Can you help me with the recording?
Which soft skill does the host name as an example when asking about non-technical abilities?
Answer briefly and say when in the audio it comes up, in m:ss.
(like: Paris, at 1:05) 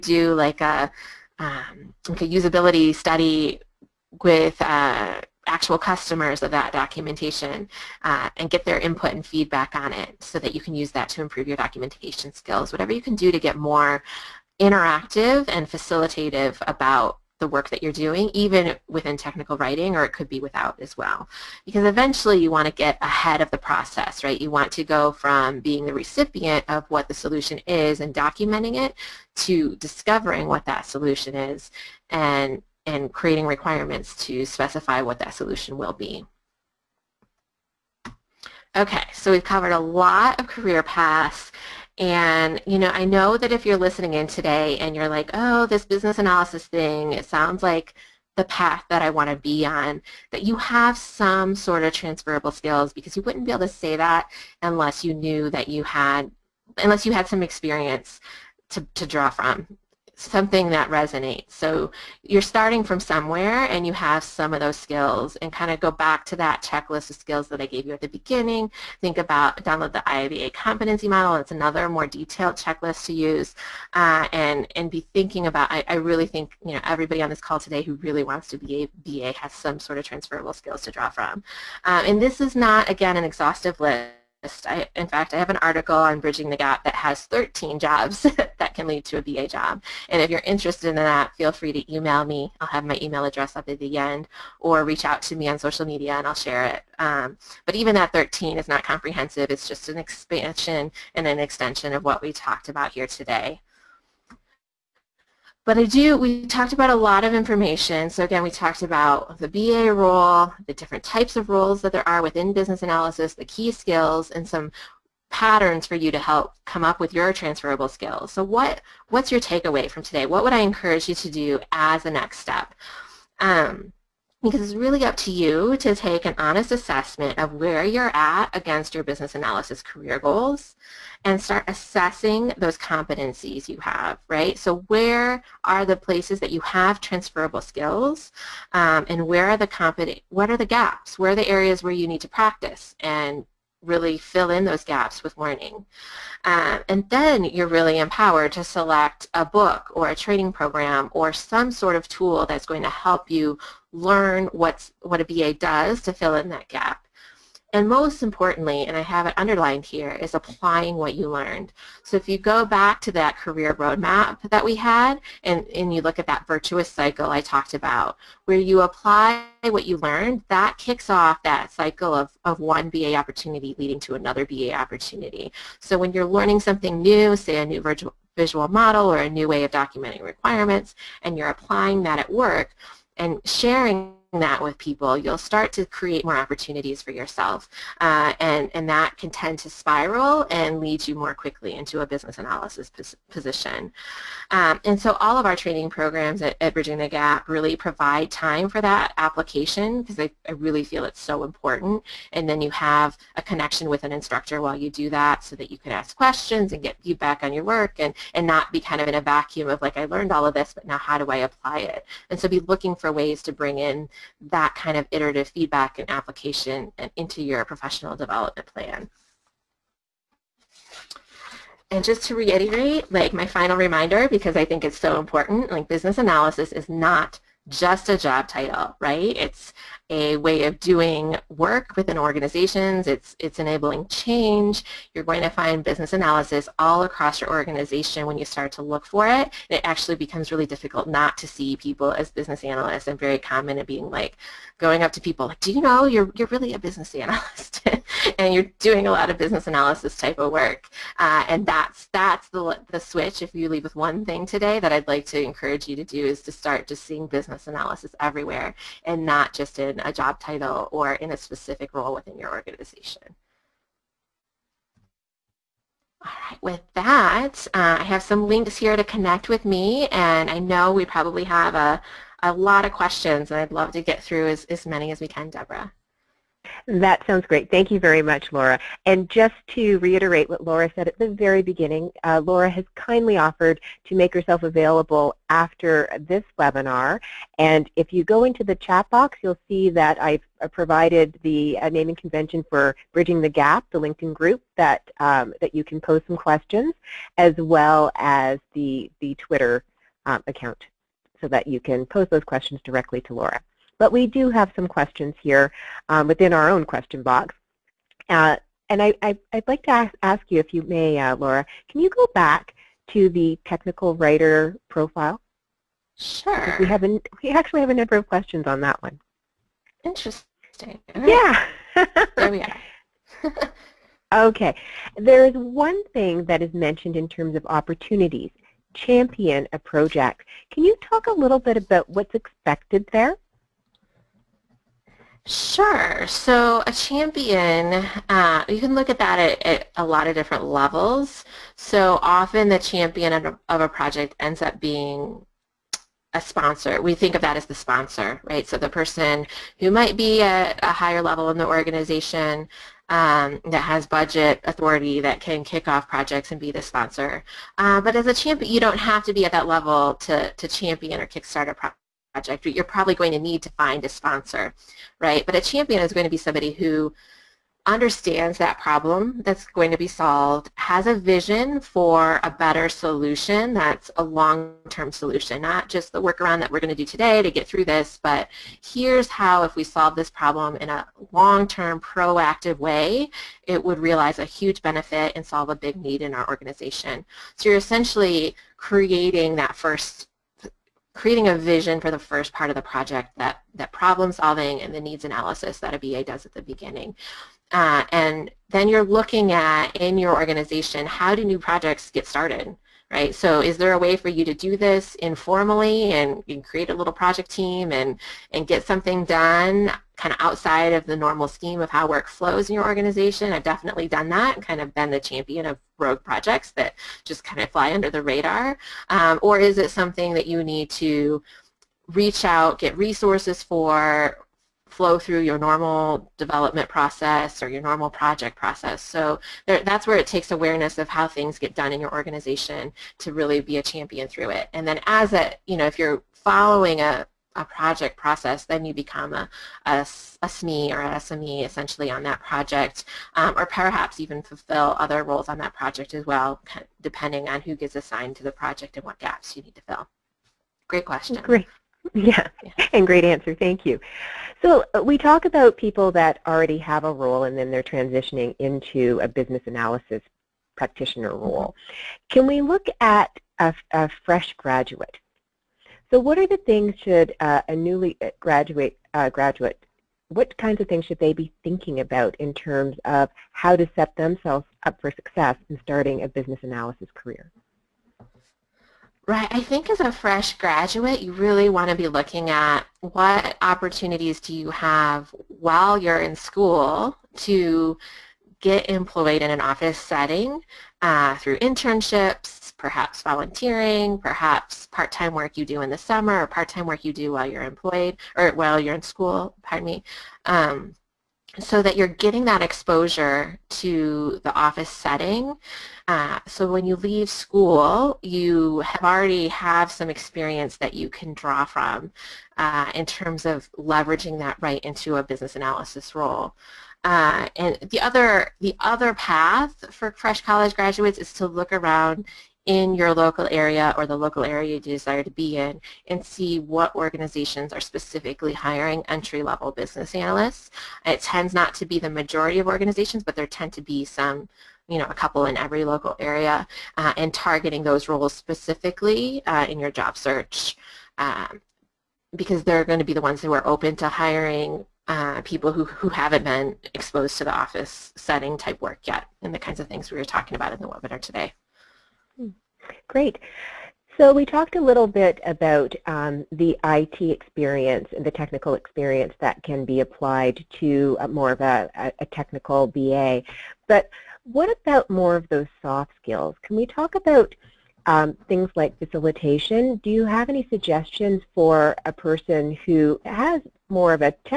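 facilitation, at 9:28.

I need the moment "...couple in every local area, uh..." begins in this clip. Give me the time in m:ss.
8:55.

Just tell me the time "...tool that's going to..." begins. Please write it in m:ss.
2:32.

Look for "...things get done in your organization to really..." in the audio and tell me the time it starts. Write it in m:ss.
7:11.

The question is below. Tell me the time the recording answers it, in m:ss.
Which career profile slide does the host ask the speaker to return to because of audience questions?
5:13.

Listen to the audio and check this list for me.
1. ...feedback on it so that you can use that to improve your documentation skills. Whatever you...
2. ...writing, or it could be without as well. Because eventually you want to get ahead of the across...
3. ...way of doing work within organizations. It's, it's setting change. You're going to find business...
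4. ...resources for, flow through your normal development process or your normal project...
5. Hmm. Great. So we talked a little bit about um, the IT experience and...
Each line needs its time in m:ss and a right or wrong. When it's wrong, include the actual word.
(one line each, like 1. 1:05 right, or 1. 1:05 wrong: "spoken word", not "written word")
1. 0:09 right
2. 0:19 wrong: "process", not "across"
3. 3:50 wrong: "enabling", not "setting"
4. 7:02 right
5. 9:12 right.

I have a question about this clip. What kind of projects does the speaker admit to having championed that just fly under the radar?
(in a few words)
rogue projects.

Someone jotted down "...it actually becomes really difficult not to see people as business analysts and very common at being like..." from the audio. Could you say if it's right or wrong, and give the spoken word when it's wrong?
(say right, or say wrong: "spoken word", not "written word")
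right.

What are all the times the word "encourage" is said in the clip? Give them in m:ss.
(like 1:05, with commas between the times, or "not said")
2:00, 4:15.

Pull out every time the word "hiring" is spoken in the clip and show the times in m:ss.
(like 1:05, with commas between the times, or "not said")
8:48, 9:04.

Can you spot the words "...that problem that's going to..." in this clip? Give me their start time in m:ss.
6:08.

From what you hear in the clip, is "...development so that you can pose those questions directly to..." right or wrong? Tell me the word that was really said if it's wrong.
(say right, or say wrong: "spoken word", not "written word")
wrong: "account", not "development".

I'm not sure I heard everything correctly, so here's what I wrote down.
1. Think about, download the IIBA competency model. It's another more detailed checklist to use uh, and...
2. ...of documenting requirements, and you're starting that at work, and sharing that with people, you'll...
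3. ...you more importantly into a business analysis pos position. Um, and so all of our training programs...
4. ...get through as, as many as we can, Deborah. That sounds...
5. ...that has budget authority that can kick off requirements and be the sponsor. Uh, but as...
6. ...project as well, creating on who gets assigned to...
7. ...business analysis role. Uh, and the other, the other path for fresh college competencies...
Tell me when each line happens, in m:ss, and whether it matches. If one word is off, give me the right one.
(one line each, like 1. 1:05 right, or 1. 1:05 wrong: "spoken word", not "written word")
1. 1:09 right
2. 2:59 wrong: "applying", not "starting"
3. 3:11 wrong: "quickly", not "importantly"
4. 4:34 right
5. 5:53 wrong: "projects", not "requirements"
6. 7:25 wrong: "depending", not "creating"
7. 8:35 wrong: "graduates", not "competencies".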